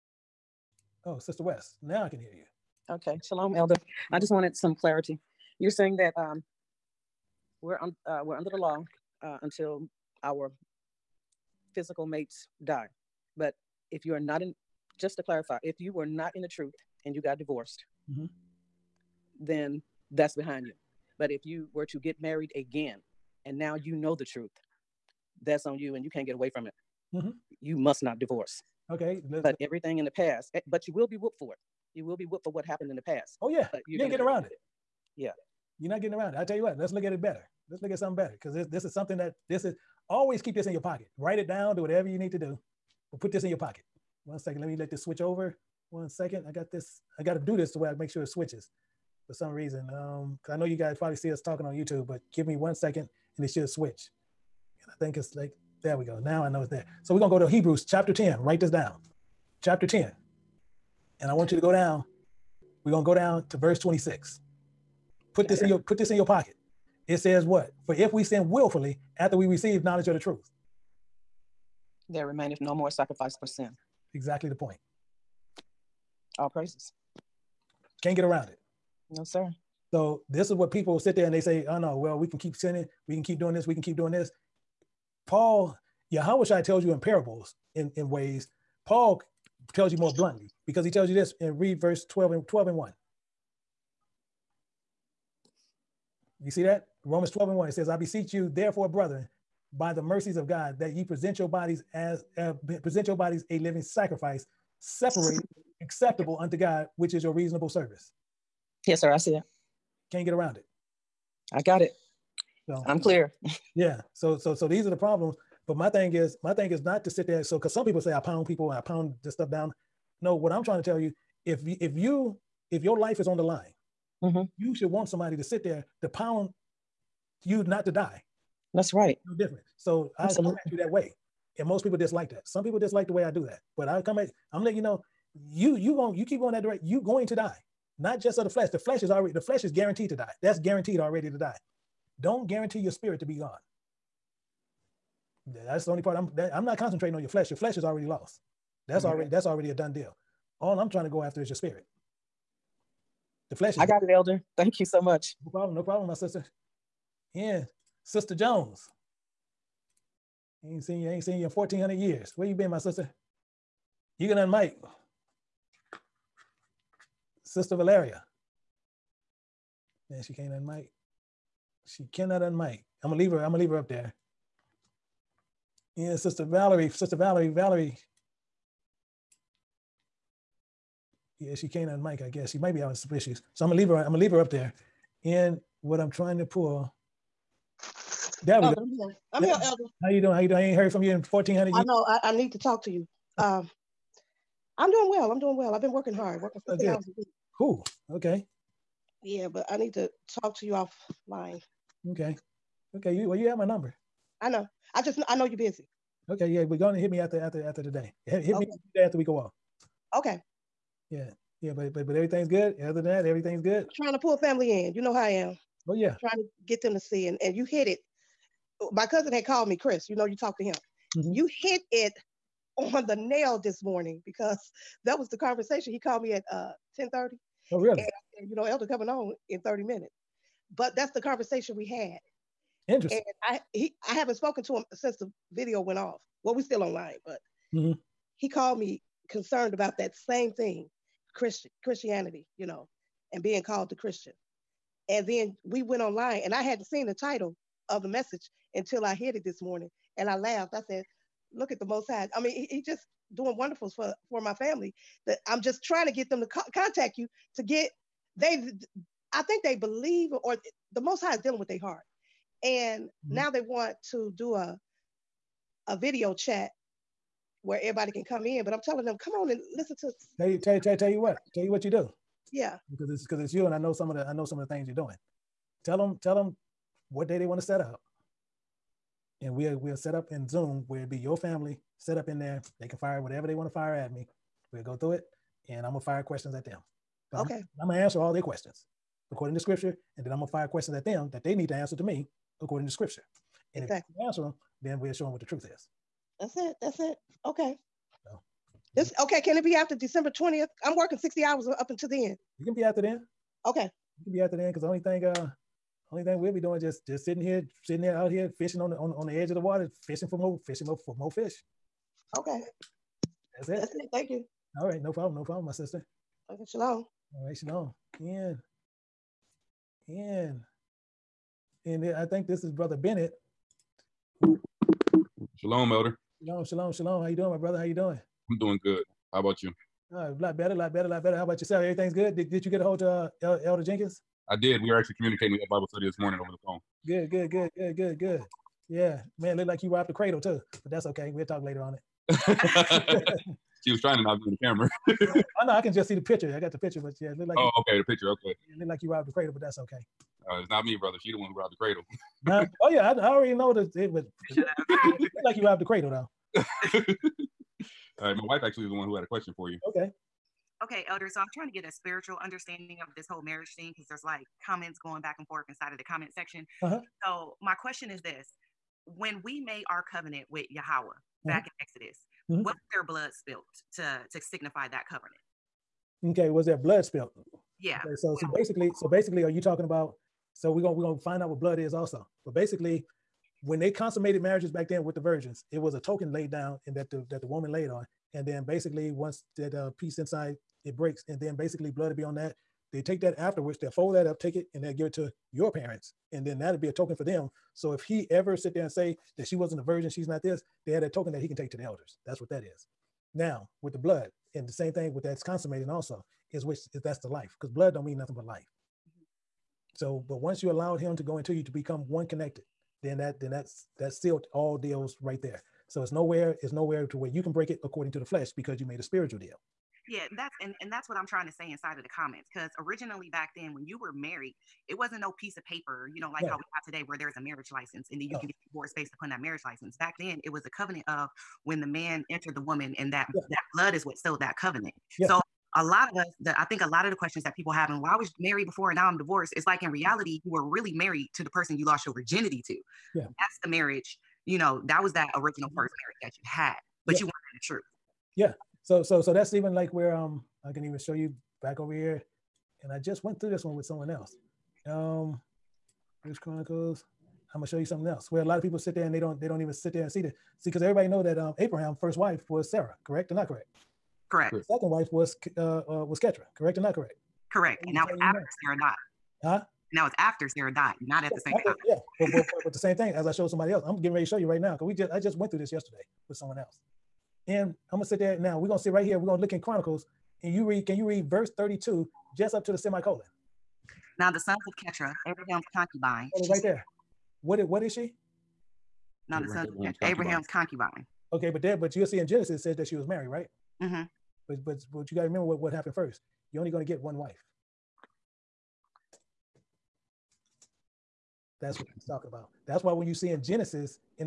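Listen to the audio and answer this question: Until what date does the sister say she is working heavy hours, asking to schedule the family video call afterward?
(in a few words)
December 20th.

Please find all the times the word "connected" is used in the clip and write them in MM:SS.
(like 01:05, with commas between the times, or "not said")
06:52.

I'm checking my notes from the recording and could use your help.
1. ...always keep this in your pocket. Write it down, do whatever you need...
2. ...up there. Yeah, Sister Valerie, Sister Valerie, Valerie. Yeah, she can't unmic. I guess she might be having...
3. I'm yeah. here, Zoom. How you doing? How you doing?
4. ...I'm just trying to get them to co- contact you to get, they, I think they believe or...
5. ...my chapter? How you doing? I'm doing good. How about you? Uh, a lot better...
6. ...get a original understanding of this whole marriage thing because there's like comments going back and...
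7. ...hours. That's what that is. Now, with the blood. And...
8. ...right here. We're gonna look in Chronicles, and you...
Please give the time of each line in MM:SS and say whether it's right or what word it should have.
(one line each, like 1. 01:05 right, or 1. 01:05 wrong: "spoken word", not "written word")
1. 00:40 right
2. 02:53 right
3. 03:09 wrong: "Elder", not "Zoom"
4. 04:15 right
5. 05:27 wrong: "brother", not "chapter"
6. 06:01 wrong: "spiritual", not "original"
7. 06:41 wrong: "elders", not "hours"
8. 07:58 right.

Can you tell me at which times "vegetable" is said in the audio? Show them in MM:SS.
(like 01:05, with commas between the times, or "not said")
not said.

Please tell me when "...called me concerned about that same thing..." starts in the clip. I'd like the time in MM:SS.
03:58.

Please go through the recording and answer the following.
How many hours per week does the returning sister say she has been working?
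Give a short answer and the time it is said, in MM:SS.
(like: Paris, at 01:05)
50, at 03:16.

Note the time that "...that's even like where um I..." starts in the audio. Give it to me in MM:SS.
07:29.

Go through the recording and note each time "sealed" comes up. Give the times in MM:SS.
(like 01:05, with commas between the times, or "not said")
06:54, 07:14.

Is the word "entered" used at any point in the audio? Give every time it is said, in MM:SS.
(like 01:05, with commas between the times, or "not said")
07:12.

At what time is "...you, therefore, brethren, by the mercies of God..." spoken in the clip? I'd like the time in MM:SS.
01:38.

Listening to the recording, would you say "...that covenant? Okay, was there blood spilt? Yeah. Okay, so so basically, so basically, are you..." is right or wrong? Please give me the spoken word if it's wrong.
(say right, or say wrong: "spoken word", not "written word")
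right.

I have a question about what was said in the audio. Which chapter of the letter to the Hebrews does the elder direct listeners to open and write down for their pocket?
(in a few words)
Chapter 10.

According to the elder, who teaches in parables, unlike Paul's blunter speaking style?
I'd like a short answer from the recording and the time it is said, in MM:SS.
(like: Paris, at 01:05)
Yahushua, at 01:26.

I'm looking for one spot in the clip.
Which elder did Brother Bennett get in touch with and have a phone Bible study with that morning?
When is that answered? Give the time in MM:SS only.
05:33.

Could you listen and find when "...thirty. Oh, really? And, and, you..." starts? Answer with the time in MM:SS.
03:47.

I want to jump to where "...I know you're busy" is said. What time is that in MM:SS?
03:25.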